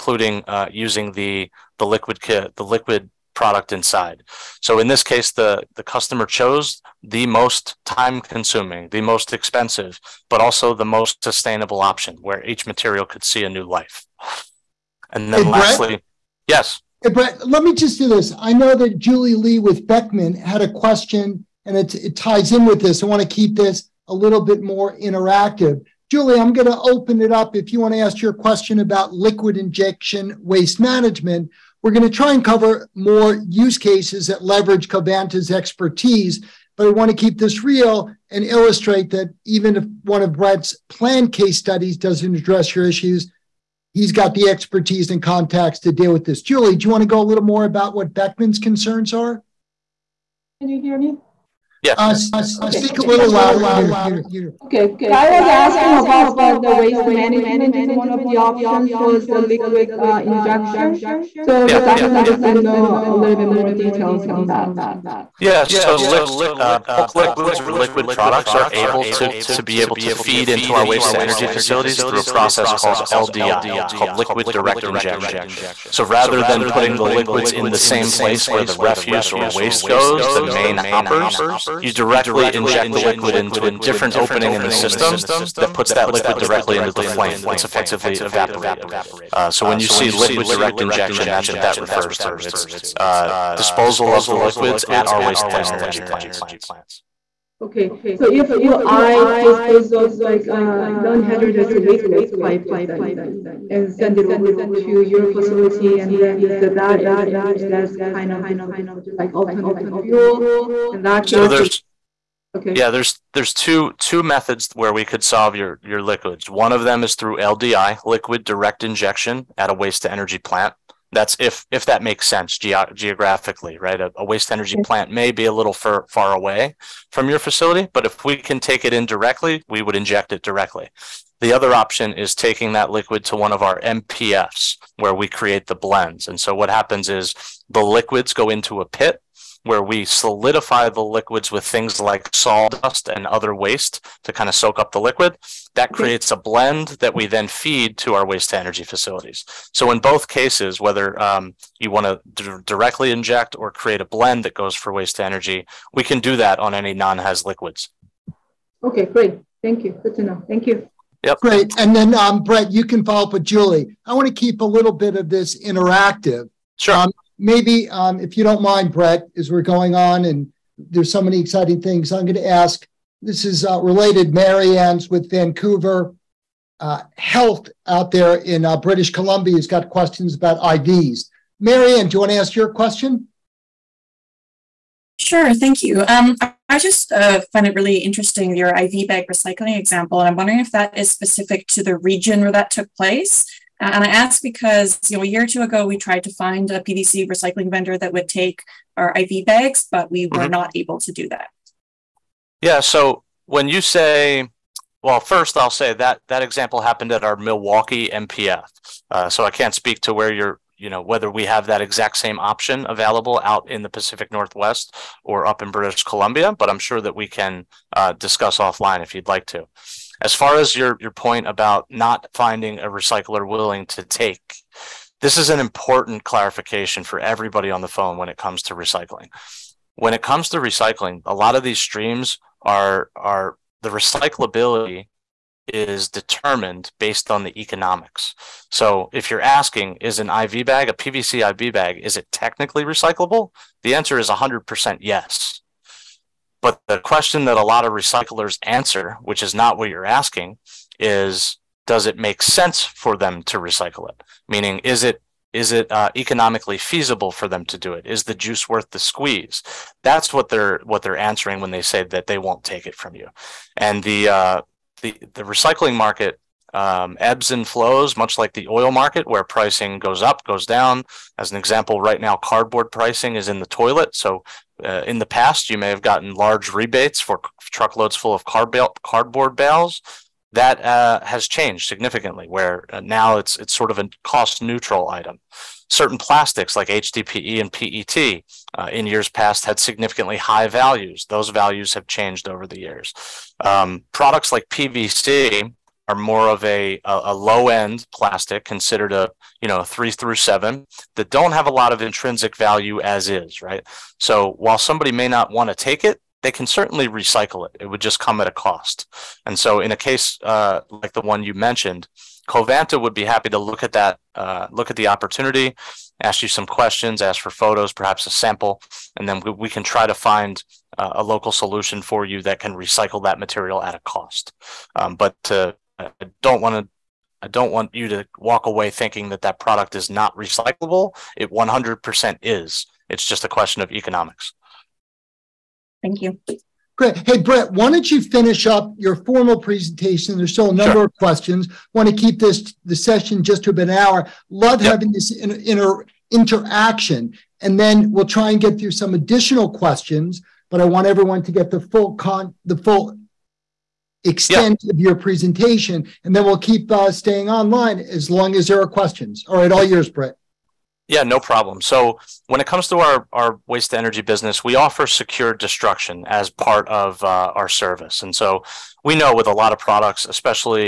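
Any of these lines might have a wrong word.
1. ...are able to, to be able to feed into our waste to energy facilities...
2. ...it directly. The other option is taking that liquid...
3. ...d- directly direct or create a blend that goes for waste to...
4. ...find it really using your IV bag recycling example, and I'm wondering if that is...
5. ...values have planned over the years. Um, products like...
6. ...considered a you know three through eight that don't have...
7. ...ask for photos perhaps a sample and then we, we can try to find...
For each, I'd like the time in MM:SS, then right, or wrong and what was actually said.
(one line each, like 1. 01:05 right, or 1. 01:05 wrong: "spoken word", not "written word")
1. 01:08 right
2. 02:10 right
3. 02:32 wrong: "inject", not "direct"
4. 03:07 wrong: "interesting", not "using"
5. 04:51 wrong: "changed", not "planned"
6. 04:58 wrong: "seven", not "eight"
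7. 05:17 right.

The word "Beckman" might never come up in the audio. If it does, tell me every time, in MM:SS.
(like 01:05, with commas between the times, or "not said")
00:19, 00:48.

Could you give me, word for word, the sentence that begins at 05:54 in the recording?
of your presentation, and then we'll keep uh, staying online as long as there are questions.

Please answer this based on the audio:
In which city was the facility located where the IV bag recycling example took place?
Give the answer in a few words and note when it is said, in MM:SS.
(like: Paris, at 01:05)
Milwaukee, at 03:27.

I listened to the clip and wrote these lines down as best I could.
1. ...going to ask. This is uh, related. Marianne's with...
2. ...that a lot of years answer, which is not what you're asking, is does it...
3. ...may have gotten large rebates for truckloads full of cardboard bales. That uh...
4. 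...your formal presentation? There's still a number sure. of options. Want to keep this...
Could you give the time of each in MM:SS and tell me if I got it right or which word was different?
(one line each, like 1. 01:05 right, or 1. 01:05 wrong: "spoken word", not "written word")
1. 02:52 right
2. 04:07 wrong: "recyclers", not "years"
3. 04:35 right
4. 05:38 wrong: "questions", not "options".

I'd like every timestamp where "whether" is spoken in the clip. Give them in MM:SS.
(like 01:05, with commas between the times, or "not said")
02:30, 03:31.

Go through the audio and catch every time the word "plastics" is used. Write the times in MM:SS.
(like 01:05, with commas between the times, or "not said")
04:46, 04:58.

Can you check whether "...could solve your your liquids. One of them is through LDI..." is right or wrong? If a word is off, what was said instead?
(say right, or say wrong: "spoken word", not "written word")
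right.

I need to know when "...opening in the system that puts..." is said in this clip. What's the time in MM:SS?
01:24.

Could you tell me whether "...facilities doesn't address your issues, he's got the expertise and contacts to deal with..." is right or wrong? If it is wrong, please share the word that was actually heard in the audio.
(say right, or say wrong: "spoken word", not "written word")
wrong: "studies", not "facilities".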